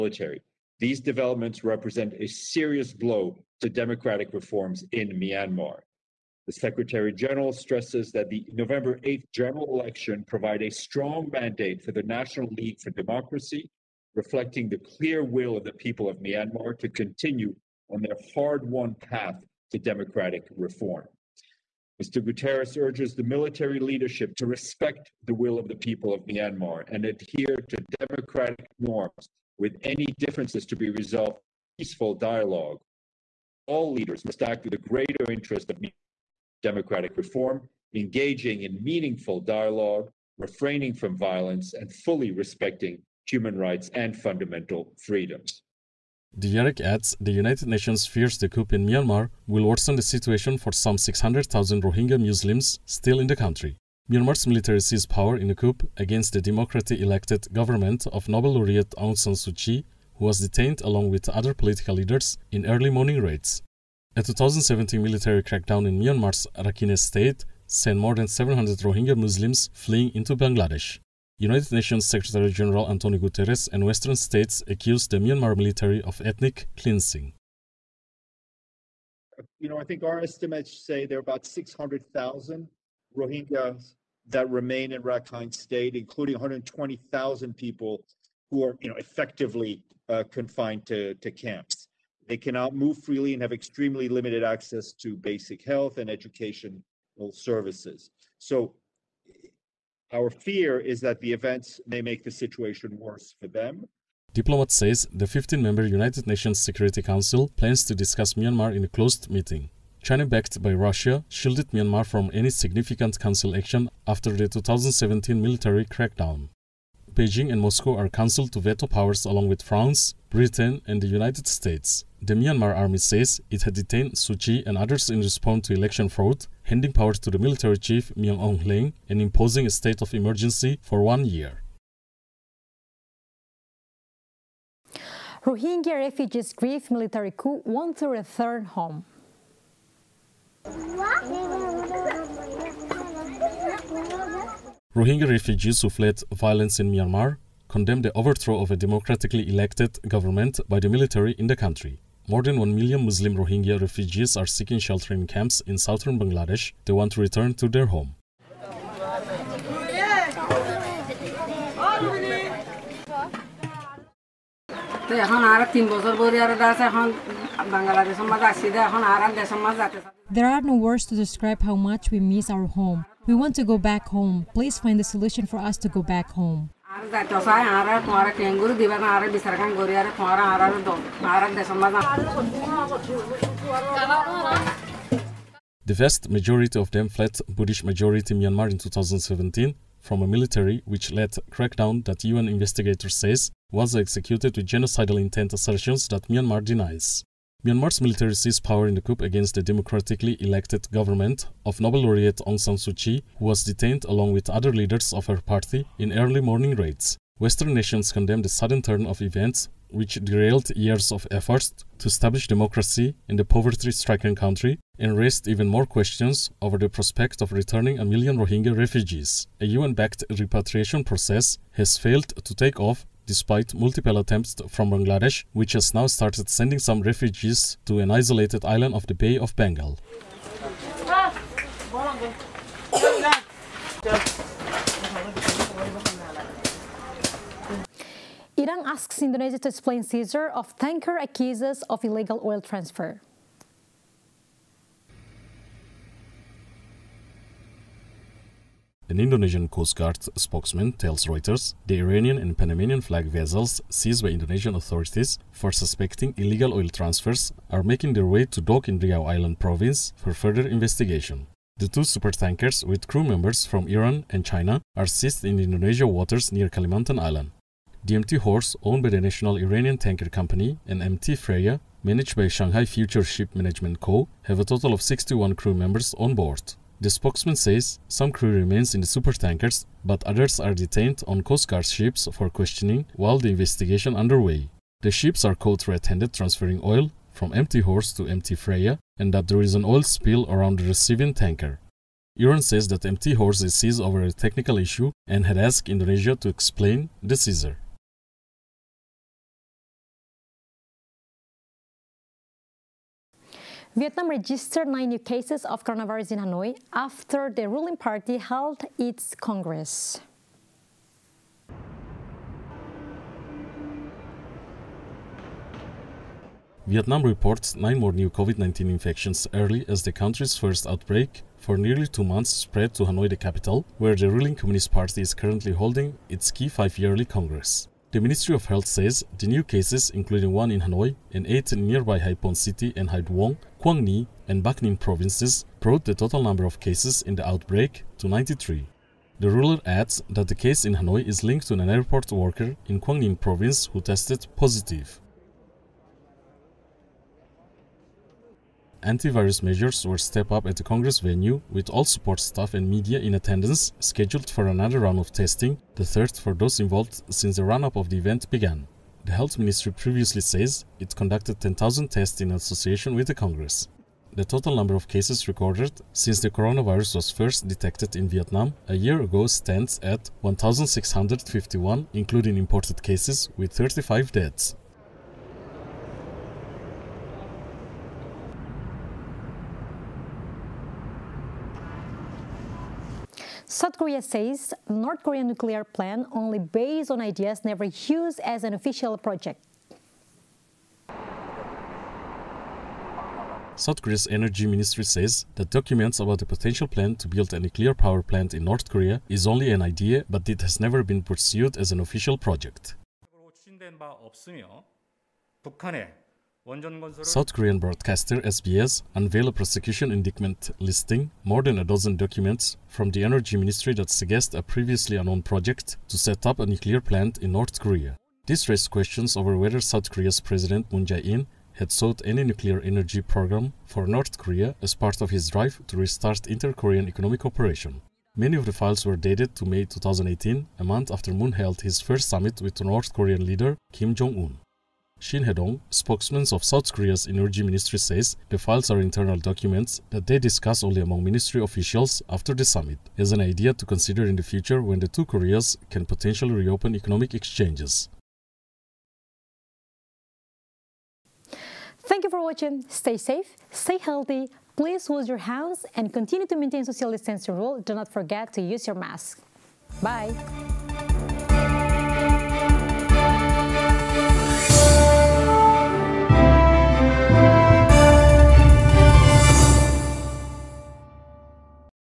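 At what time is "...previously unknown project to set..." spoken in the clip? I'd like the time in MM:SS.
06:54.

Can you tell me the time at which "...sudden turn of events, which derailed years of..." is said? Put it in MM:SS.
03:28.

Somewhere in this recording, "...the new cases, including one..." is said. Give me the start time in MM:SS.
05:29.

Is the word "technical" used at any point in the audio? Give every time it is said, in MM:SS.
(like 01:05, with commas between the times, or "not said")
04:54.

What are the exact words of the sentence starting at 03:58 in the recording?
Iran asks Indonesia to explain seizure of tanker accuses of illegal oil transfer.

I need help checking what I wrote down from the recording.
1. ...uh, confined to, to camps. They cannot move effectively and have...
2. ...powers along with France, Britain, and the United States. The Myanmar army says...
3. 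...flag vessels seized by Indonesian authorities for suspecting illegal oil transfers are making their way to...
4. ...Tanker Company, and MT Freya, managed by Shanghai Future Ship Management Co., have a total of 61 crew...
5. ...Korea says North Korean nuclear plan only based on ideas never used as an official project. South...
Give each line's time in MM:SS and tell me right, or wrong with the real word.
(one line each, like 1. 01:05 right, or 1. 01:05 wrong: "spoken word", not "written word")
1. 01:30 wrong: "freely", not "effectively"
2. 01:58 right
3. 04:13 right
4. 04:29 right
5. 06:23 right.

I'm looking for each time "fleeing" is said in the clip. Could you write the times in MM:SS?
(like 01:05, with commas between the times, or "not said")
01:09.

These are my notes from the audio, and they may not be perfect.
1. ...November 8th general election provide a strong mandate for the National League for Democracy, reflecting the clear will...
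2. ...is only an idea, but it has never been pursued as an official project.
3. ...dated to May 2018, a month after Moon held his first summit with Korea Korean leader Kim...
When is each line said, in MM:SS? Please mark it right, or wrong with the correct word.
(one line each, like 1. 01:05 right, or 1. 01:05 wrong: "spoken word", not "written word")
1. 00:08 right
2. 06:39 right
3. 07:09 wrong: "North", not "Korea".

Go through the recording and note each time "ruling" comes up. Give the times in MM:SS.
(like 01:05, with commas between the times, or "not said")
05:07, 05:24.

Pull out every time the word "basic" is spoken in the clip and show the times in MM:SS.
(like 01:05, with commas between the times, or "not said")
01:35.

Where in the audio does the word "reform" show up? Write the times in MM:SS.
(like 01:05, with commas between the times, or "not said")
00:04, 00:20, 00:37.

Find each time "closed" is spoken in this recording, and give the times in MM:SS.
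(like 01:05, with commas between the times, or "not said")
01:48.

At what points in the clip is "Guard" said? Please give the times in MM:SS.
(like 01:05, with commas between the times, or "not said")
04:09, 04:41.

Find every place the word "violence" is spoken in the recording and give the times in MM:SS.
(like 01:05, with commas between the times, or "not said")
00:41, 02:26.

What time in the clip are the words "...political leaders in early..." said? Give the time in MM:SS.
01:01.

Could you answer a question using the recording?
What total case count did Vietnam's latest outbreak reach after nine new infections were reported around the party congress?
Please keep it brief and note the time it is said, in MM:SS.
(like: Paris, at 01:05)
93, at 05:38.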